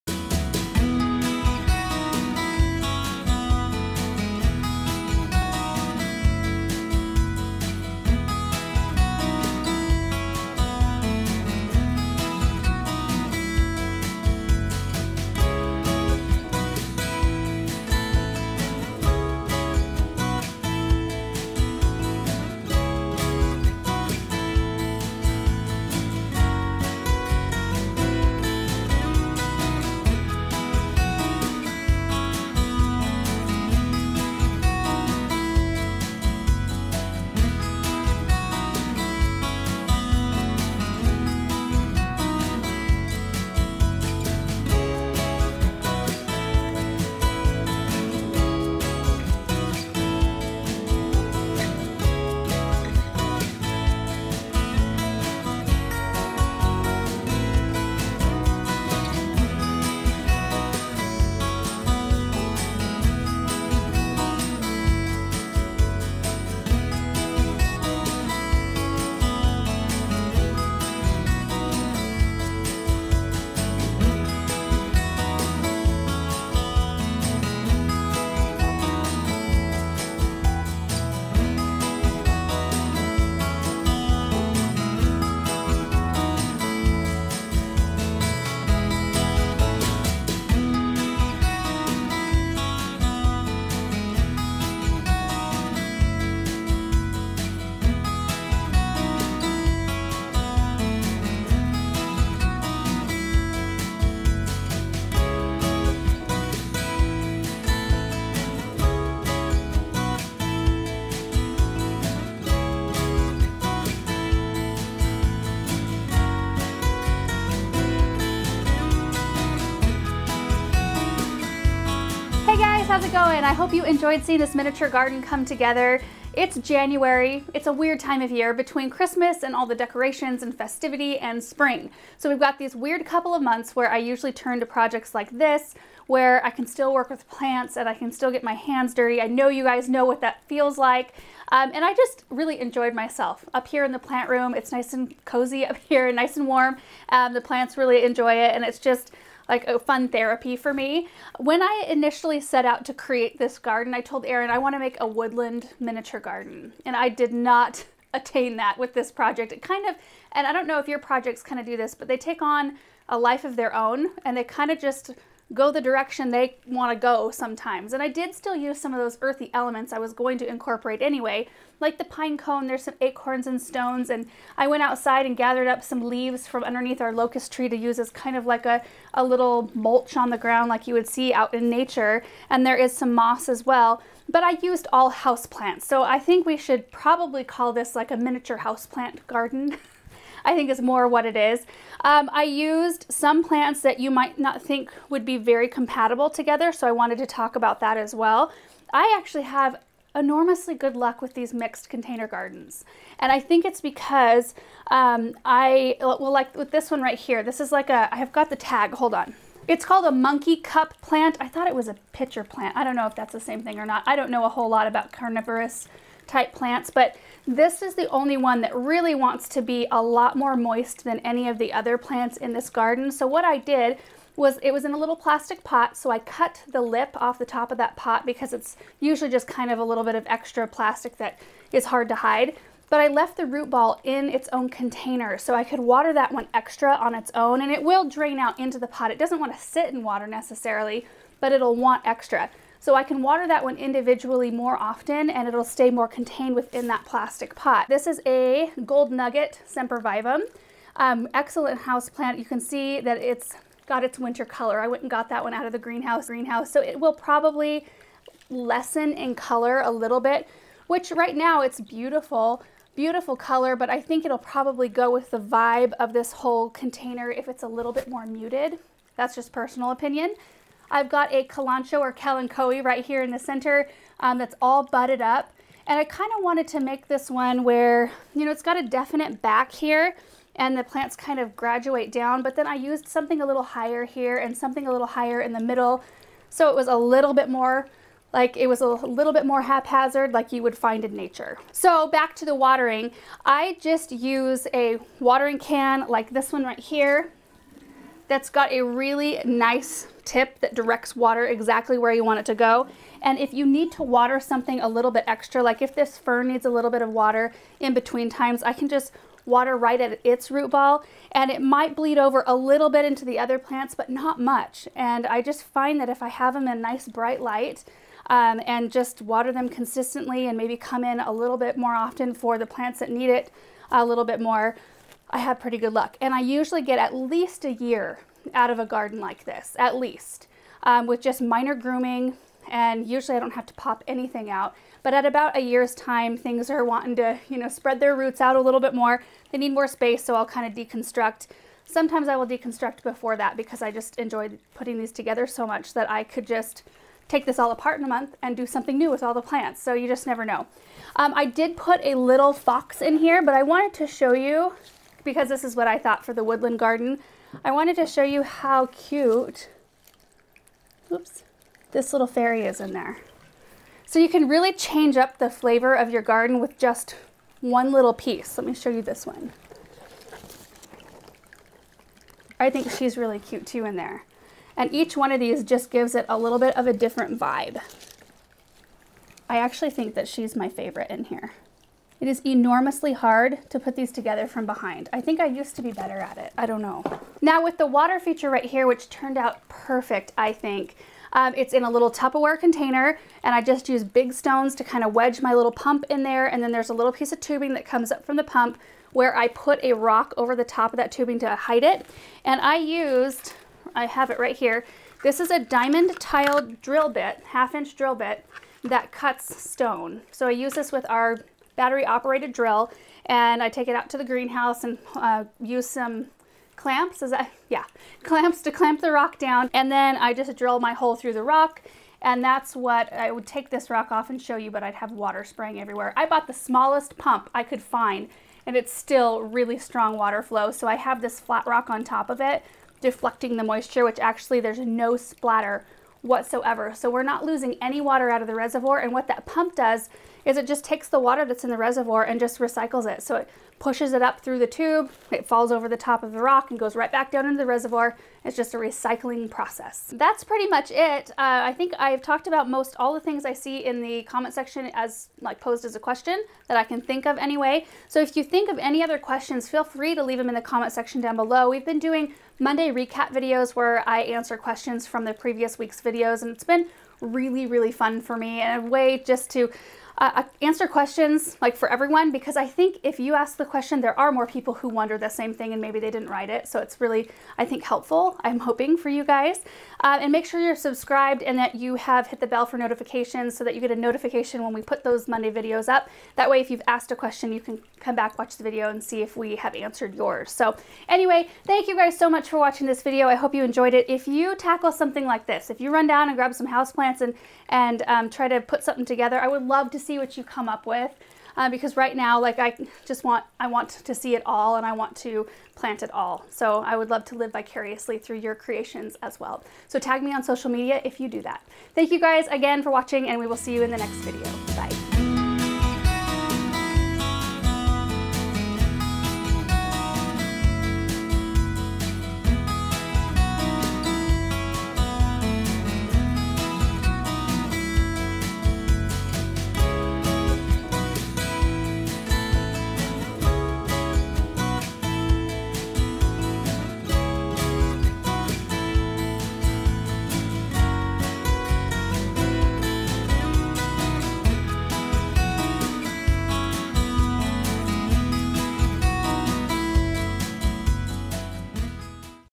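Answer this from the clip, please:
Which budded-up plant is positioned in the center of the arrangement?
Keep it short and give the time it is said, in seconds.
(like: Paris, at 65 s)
Kalanchoe, at 272 s.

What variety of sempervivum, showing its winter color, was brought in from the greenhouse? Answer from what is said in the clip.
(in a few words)
Gold nugget.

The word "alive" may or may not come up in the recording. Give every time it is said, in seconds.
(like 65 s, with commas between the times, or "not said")
not said.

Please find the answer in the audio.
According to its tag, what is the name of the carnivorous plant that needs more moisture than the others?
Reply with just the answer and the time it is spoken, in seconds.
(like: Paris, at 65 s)
Monkey cup plant, at 210 s.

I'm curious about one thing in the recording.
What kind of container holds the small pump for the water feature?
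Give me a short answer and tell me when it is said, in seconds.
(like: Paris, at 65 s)
Tupperware container, at 392 s.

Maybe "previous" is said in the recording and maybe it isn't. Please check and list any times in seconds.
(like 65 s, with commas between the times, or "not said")
465 s.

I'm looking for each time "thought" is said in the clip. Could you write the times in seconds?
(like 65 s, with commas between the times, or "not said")
211 s, 355 s.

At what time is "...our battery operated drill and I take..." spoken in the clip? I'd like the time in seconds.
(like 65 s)
411 s.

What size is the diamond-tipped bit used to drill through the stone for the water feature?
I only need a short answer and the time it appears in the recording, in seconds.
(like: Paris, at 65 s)
Half inch, at 407 s.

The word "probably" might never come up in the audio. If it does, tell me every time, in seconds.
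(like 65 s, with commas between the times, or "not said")
186 s, 257 s, 264 s.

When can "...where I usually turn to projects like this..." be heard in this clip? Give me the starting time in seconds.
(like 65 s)
133 s.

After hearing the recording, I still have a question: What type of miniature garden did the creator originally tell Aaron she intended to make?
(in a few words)
A woodland miniature garden.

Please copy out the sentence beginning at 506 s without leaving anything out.
So I would love to live vicariously through your creations as well.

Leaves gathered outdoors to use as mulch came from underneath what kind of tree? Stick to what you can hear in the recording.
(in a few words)
Locust tree.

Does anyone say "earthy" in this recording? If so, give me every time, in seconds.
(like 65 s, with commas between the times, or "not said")
169 s.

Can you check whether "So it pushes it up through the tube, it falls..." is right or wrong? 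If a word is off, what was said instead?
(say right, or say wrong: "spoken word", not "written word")
right.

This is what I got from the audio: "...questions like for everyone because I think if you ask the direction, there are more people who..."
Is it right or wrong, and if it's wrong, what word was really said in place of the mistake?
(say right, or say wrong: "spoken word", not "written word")
wrong: "question", not "direction".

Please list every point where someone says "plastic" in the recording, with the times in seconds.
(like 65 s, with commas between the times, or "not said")
225 s, 230 s, 247 s.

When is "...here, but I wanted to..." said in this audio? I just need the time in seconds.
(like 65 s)
353 s.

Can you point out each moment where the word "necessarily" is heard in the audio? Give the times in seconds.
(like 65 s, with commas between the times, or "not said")
240 s.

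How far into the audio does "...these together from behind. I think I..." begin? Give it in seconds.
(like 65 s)
383 s.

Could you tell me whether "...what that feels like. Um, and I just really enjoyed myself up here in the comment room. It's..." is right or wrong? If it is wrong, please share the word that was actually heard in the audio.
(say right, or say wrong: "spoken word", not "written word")
wrong: "plant", not "comment".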